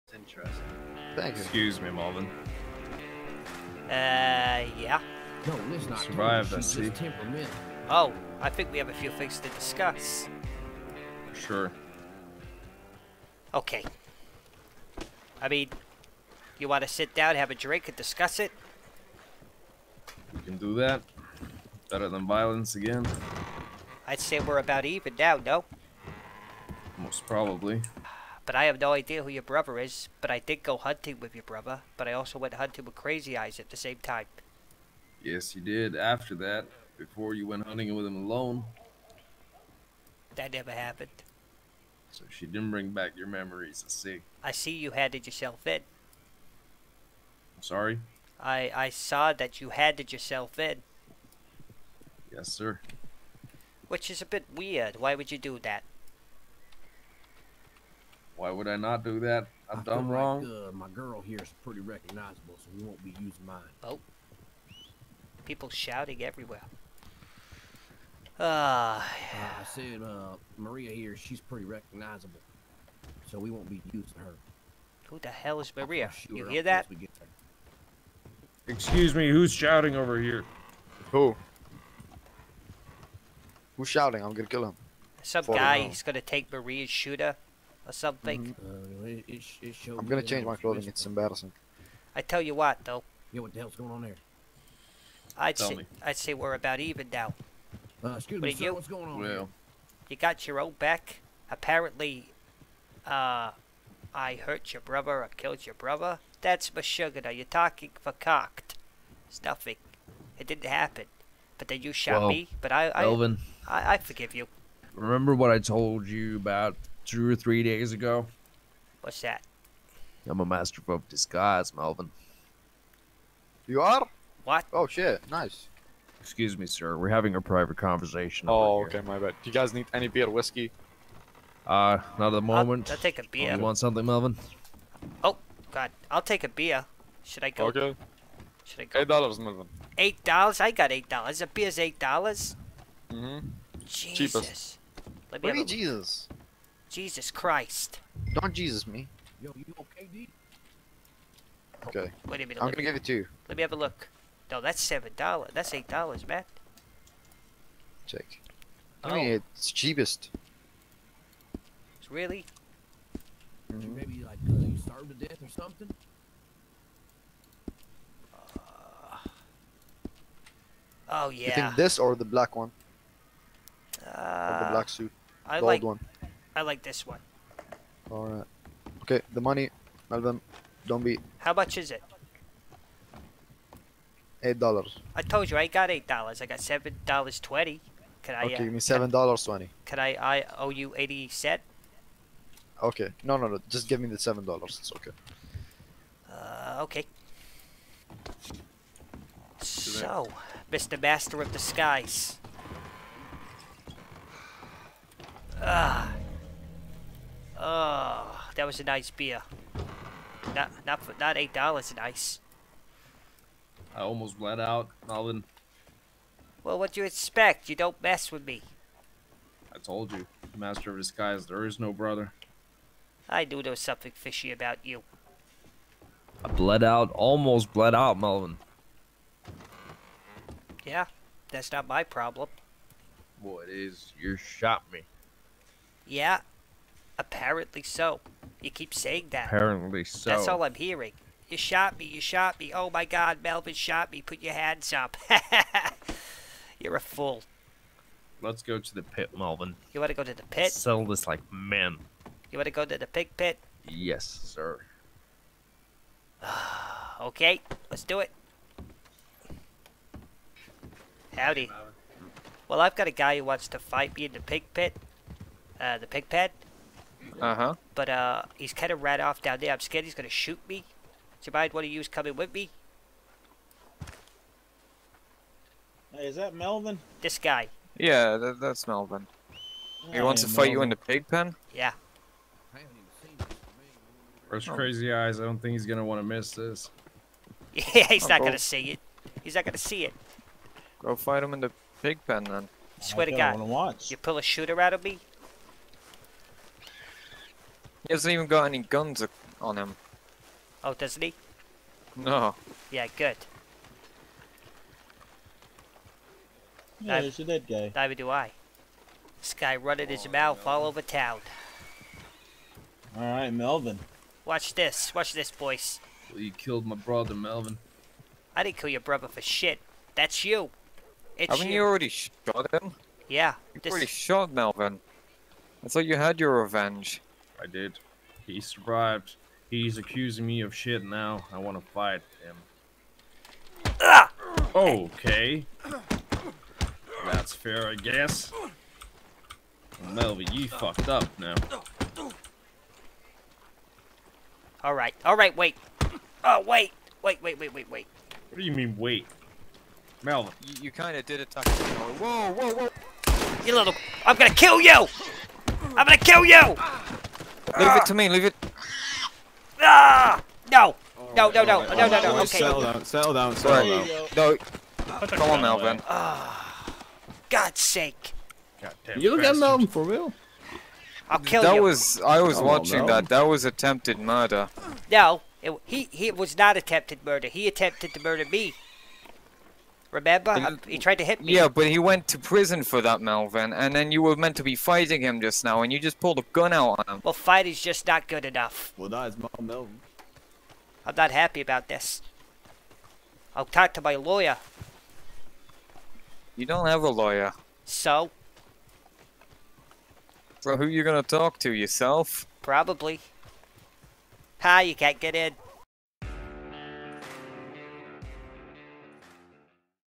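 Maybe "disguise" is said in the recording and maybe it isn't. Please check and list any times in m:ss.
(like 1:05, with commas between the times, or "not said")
2:01, 3:21, 3:40.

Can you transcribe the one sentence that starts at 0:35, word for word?
Yes, you did after that, before you went hunting with him alone.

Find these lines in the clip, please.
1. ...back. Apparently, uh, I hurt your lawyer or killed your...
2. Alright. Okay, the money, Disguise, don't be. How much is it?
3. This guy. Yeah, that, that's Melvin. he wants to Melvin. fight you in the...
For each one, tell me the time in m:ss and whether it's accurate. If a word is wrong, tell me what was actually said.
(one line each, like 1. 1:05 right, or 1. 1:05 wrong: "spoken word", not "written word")
1. 1:40 wrong: "brother", not "lawyer"
2. 2:58 wrong: "Melvin", not "Disguise"
3. 4:37 right.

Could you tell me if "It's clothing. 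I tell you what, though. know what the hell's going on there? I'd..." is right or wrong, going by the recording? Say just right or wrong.
wrong.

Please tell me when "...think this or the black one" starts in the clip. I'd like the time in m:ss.
2:51.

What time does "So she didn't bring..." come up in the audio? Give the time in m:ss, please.
0:42.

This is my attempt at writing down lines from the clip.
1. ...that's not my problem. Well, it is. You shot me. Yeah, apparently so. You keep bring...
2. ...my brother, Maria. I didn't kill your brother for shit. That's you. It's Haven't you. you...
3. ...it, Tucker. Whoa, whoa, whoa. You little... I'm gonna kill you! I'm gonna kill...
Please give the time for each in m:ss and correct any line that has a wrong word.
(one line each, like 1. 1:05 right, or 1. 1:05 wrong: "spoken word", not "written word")
1. 3:51 wrong: "saying", not "bring"
2. 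5:16 wrong: "Melvin", not "Maria"
3. 5:51 right.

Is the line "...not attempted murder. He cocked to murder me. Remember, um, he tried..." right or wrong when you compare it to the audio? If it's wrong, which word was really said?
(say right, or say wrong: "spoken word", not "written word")
wrong: "attempted", not "cocked".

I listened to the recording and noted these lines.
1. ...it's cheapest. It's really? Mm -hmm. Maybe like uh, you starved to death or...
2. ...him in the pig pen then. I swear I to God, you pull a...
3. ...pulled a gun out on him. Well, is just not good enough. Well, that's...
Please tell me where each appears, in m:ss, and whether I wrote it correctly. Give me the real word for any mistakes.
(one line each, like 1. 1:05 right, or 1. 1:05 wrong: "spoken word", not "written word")
1. 2:39 right
2. 4:51 right
3. 6:26 right.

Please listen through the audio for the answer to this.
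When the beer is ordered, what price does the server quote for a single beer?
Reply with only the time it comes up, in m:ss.
2:19.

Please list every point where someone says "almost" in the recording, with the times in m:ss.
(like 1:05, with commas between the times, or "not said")
3:34, 3:47.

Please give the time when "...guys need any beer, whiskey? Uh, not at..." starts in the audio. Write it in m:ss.
2:09.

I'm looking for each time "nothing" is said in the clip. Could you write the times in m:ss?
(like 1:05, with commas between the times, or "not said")
1:49.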